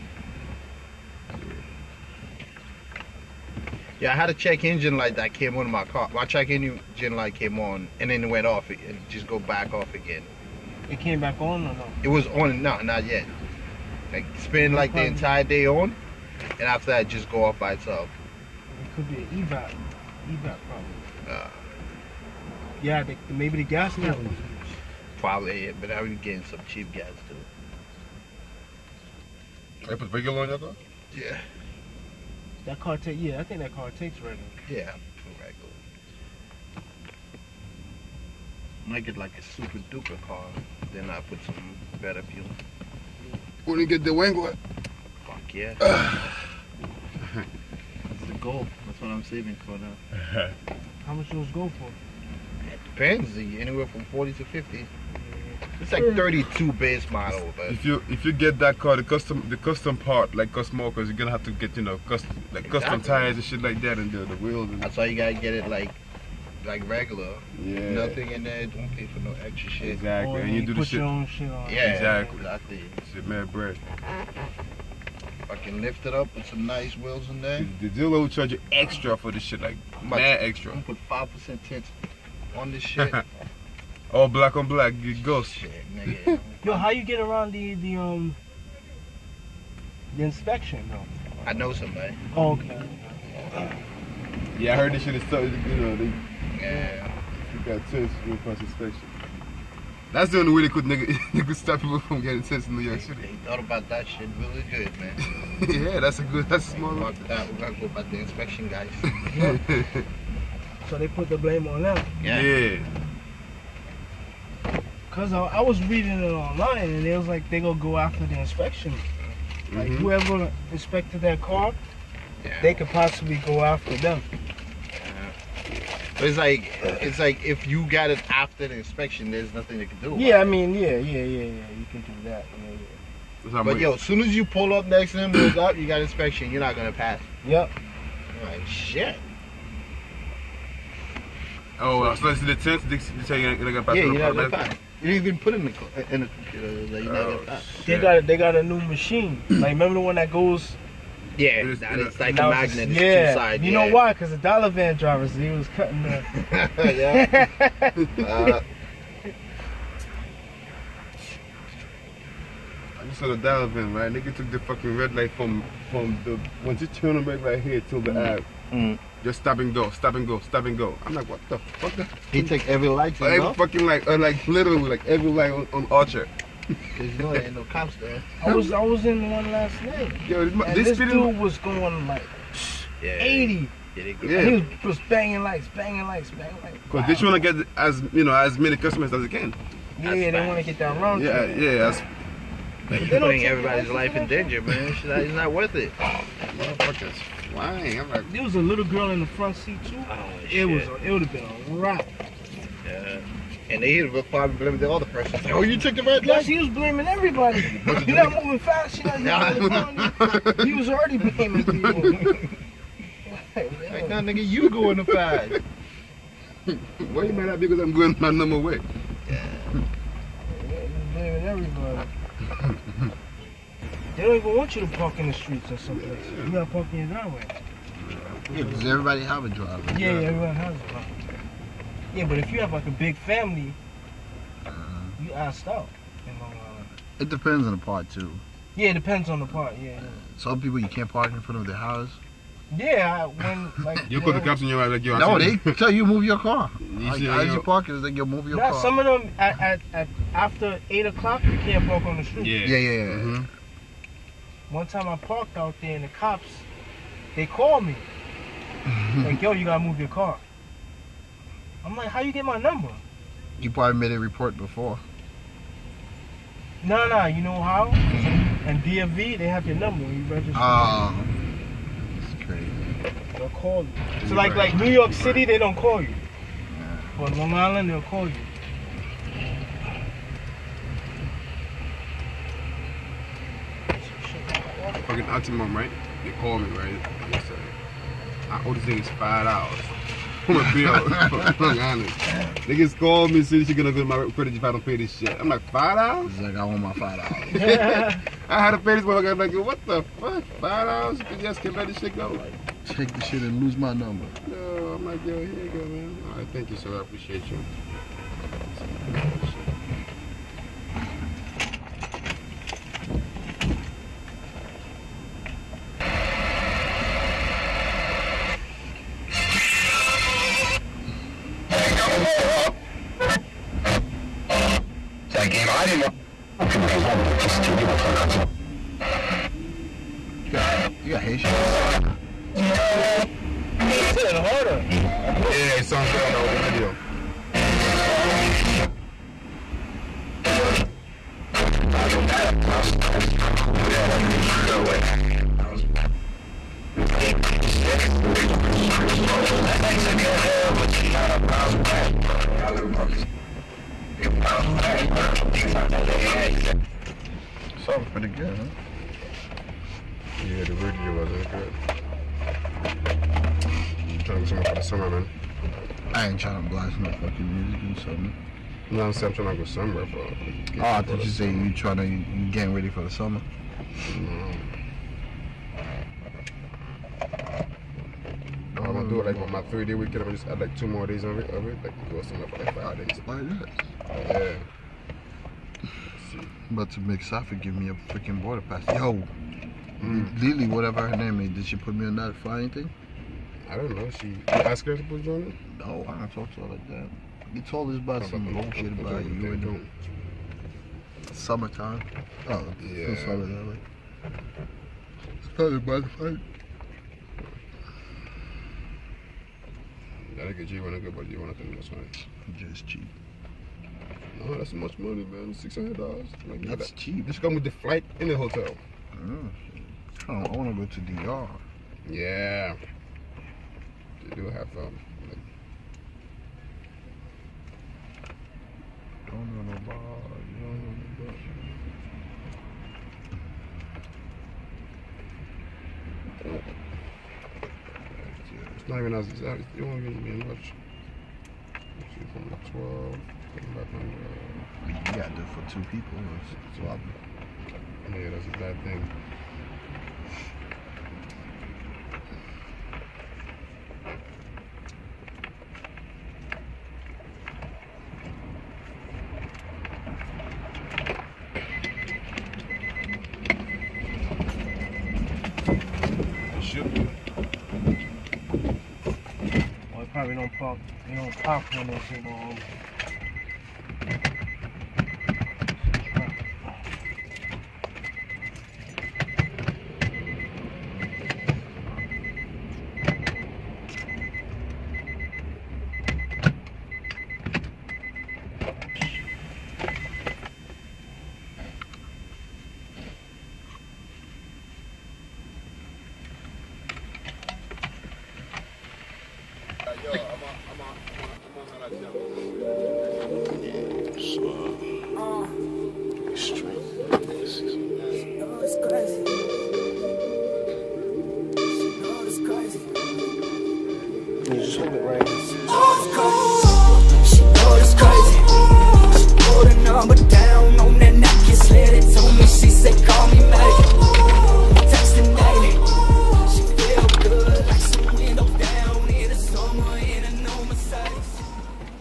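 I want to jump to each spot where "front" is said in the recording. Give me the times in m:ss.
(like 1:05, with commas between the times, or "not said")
3:19, 4:01.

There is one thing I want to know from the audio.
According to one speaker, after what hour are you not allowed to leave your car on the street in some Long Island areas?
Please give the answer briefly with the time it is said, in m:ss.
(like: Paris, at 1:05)
8 o'clock, at 4:10.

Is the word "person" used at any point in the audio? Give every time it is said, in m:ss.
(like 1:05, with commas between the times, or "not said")
3:25.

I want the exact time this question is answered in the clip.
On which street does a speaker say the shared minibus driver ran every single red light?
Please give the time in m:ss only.
2:55.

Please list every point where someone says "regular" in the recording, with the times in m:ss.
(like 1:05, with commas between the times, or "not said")
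0:30, 0:35, 1:06.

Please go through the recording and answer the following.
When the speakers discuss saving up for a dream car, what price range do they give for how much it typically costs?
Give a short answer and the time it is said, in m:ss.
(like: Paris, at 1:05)
40 to 50, at 0:53.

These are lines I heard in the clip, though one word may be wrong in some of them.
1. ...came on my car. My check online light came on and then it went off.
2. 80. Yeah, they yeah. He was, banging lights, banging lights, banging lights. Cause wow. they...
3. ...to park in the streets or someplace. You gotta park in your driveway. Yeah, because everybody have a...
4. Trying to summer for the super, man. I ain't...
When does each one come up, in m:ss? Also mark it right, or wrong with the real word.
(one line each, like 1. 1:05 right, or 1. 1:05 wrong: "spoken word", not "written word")
1. 0:05 wrong: "engine", not "online"
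2. 3:03 right
3. 3:44 right
4. 6:04 wrong: "summer", not "super".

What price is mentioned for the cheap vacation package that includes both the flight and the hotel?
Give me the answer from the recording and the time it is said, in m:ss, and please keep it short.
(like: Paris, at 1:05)
$600, at 6:55.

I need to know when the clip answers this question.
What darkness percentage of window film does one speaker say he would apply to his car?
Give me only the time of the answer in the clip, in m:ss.
1:21.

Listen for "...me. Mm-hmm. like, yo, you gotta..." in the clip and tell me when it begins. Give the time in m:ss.
4:17.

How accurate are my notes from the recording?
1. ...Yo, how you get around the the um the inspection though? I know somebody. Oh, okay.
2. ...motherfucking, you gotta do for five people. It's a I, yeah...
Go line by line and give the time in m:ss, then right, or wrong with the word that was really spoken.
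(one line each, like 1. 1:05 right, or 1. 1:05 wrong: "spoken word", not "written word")
1. 1:26 right
2. 7:23 wrong: "two", not "five".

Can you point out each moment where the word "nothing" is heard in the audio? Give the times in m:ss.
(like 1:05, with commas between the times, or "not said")
1:07, 2:09.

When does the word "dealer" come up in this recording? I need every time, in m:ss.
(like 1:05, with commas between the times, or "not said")
1:17.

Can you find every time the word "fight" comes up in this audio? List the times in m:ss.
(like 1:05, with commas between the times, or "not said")
3:35, 6:46.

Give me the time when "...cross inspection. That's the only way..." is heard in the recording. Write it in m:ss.
1:38.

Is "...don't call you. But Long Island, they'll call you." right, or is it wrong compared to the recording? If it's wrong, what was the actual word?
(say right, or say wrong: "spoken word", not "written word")
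right.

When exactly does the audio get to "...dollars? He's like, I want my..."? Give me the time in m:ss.
4:55.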